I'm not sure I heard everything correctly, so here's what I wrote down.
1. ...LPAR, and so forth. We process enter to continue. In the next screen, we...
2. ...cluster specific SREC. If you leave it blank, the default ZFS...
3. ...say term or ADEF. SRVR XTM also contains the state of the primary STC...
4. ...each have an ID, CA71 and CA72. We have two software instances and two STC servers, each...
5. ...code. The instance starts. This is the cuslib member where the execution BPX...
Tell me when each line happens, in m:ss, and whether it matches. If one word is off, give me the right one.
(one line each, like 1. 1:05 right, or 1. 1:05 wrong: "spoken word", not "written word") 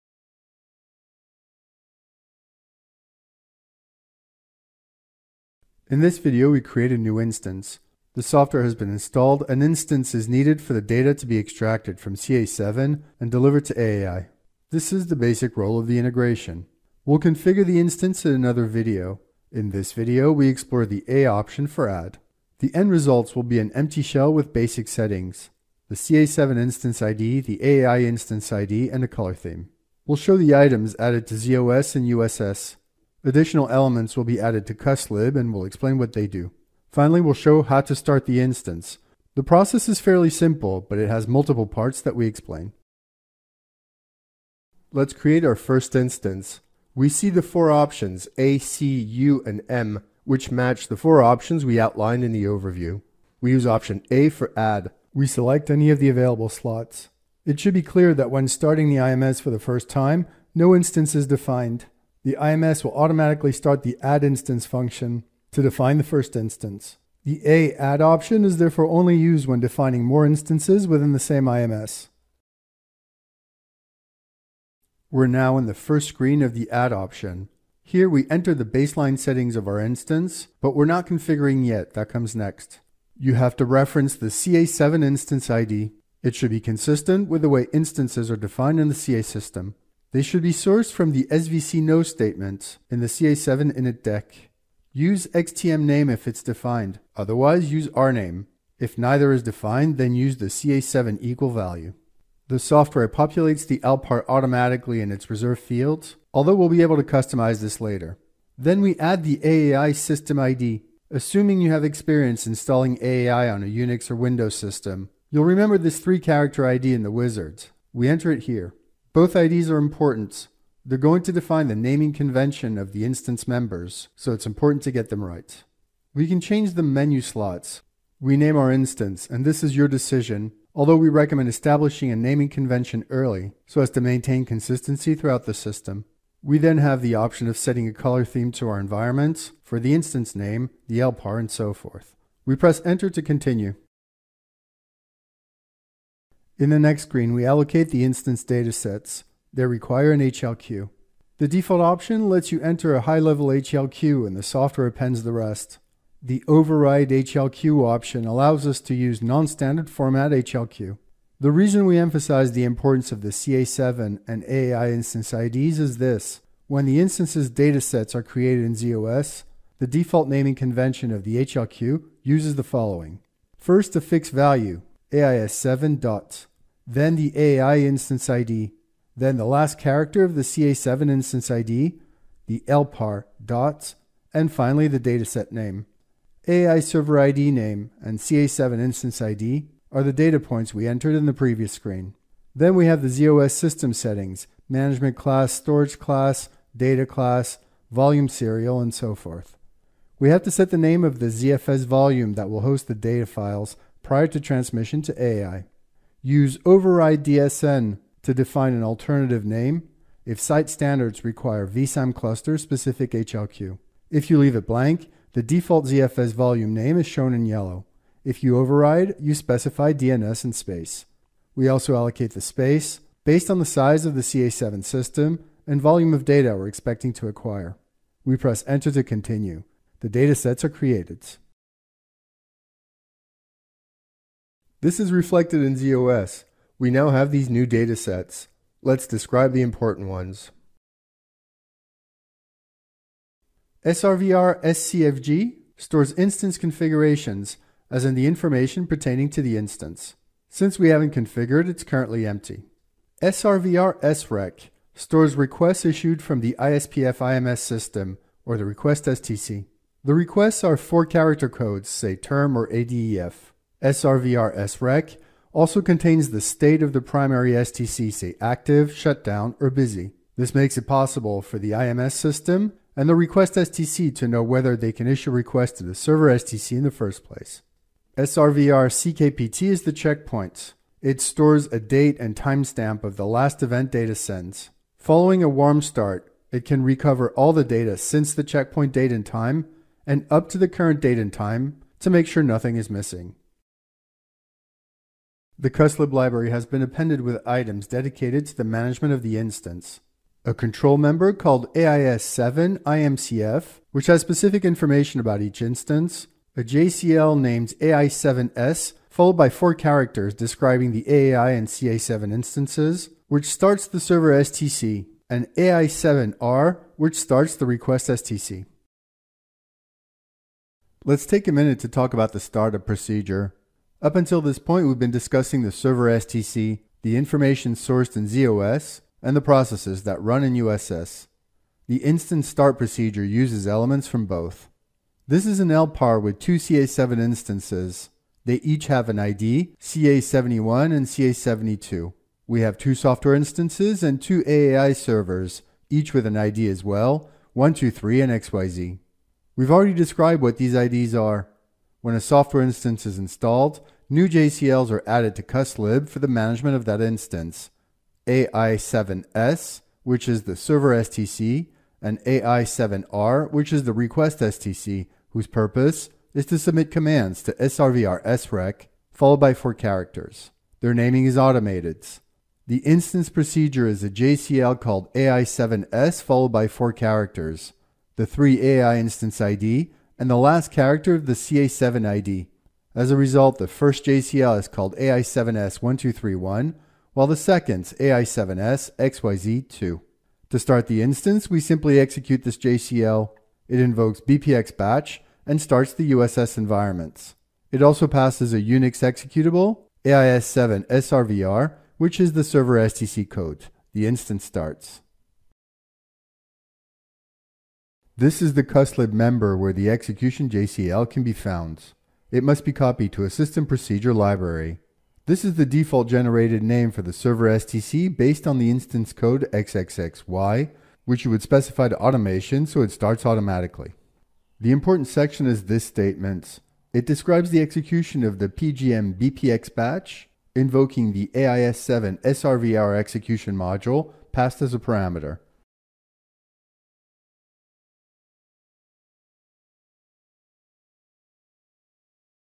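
1. 2:20 wrong: "press", not "process"
2. 3:32 wrong: "HLQ", not "SREC"
3. 4:21 wrong: "SREC", not "XTM"
4. 5:38 wrong: "AAI", not "STC"
5. 6:43 wrong: "JCL", not "BPX".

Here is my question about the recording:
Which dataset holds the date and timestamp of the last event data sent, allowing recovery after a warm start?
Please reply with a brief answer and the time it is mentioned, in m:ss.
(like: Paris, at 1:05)
SRVR CKPT, at 4:38.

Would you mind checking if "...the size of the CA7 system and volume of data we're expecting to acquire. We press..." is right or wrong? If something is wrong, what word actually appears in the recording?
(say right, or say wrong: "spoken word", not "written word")
right.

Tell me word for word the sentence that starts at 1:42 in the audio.
The software populates the LPAR automatically in its reserved fields, although we'll be able to customize this later.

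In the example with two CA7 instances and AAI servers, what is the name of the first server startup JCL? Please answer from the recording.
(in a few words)
AI7S1231.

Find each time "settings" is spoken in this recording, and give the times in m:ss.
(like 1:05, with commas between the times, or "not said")
0:24, 1:19, 2:17, 3:13.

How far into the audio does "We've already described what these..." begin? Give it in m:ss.
5:49.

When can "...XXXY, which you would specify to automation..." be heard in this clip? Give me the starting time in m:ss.
6:59.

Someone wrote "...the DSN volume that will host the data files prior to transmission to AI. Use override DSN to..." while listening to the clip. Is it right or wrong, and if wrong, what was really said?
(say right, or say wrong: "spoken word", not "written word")
wrong: "ZFS", not "DSN".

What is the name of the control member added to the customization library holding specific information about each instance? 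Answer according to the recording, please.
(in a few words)
AIS7 IMCF.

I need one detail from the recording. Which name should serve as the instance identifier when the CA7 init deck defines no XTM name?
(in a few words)
rname.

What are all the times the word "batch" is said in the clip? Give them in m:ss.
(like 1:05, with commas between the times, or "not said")
6:34, 7:09.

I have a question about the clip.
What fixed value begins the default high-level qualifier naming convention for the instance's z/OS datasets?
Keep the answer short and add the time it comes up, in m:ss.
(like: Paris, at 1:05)
AIS7, at 2:55.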